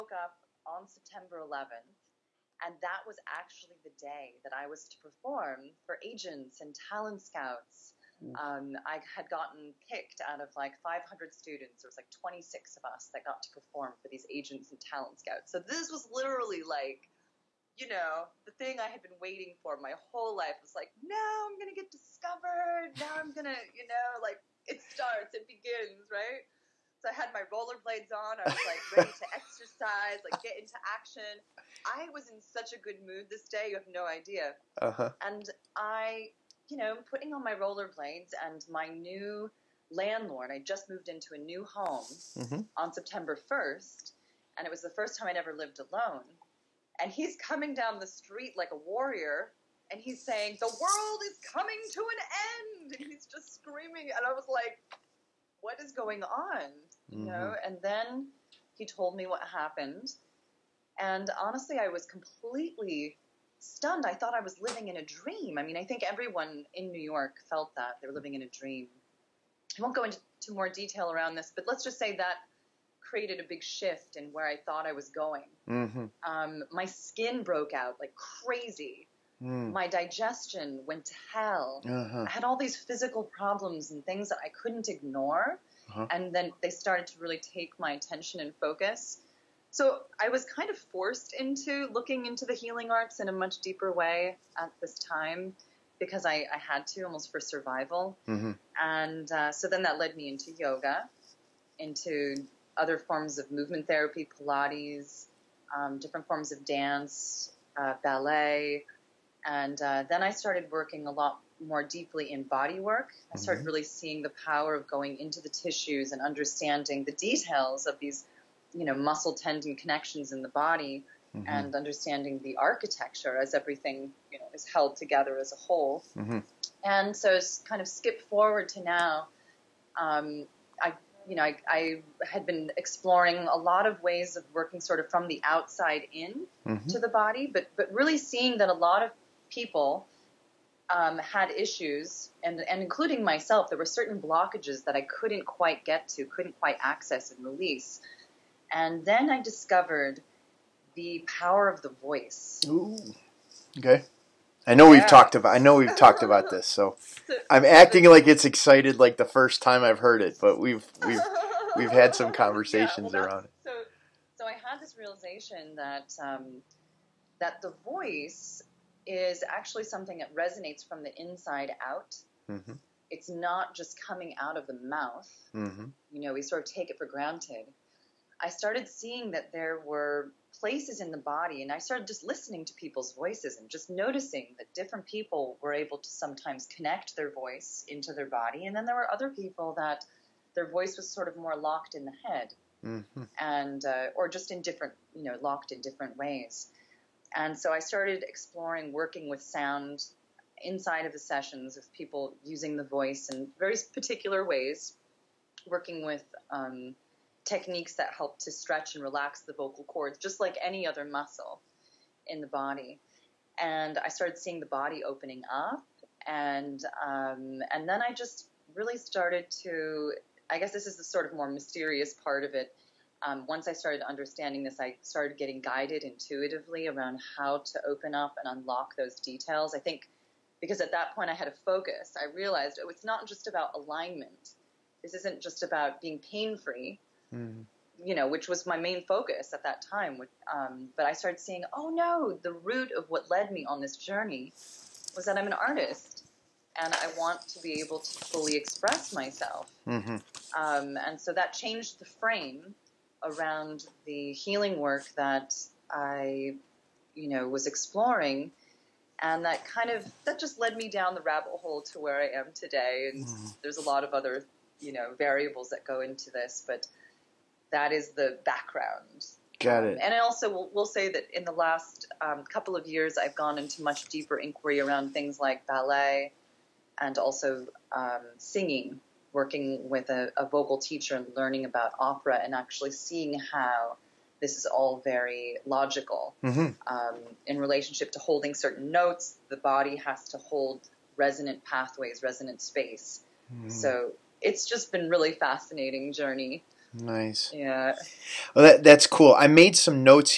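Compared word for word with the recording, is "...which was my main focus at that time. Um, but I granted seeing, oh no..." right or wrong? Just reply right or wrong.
wrong.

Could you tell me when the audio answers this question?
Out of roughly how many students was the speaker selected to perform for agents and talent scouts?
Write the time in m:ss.
0:10.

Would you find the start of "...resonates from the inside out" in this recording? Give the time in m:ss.
2:50.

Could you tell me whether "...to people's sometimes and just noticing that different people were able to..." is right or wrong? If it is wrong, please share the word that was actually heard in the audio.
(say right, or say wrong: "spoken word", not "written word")
wrong: "voices", not "sometimes".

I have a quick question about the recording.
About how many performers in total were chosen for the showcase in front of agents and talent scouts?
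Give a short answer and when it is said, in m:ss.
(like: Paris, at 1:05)
26, at 0:12.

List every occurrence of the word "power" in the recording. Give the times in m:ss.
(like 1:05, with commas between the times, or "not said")
1:54, 2:31.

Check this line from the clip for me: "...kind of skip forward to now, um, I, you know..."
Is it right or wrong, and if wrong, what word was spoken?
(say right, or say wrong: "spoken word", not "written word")
right.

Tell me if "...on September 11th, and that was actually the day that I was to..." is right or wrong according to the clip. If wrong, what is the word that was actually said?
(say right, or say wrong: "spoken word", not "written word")
right.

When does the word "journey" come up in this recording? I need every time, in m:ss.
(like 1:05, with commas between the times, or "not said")
4:03, 4:56.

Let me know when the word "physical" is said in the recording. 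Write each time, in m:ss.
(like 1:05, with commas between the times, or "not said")
1:22.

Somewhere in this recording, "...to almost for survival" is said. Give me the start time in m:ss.
1:36.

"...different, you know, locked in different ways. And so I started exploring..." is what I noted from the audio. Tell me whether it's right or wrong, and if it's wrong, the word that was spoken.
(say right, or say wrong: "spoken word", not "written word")
right.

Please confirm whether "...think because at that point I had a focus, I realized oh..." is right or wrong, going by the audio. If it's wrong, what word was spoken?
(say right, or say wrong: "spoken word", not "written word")
right.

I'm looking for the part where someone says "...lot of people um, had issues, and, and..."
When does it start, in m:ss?
2:18.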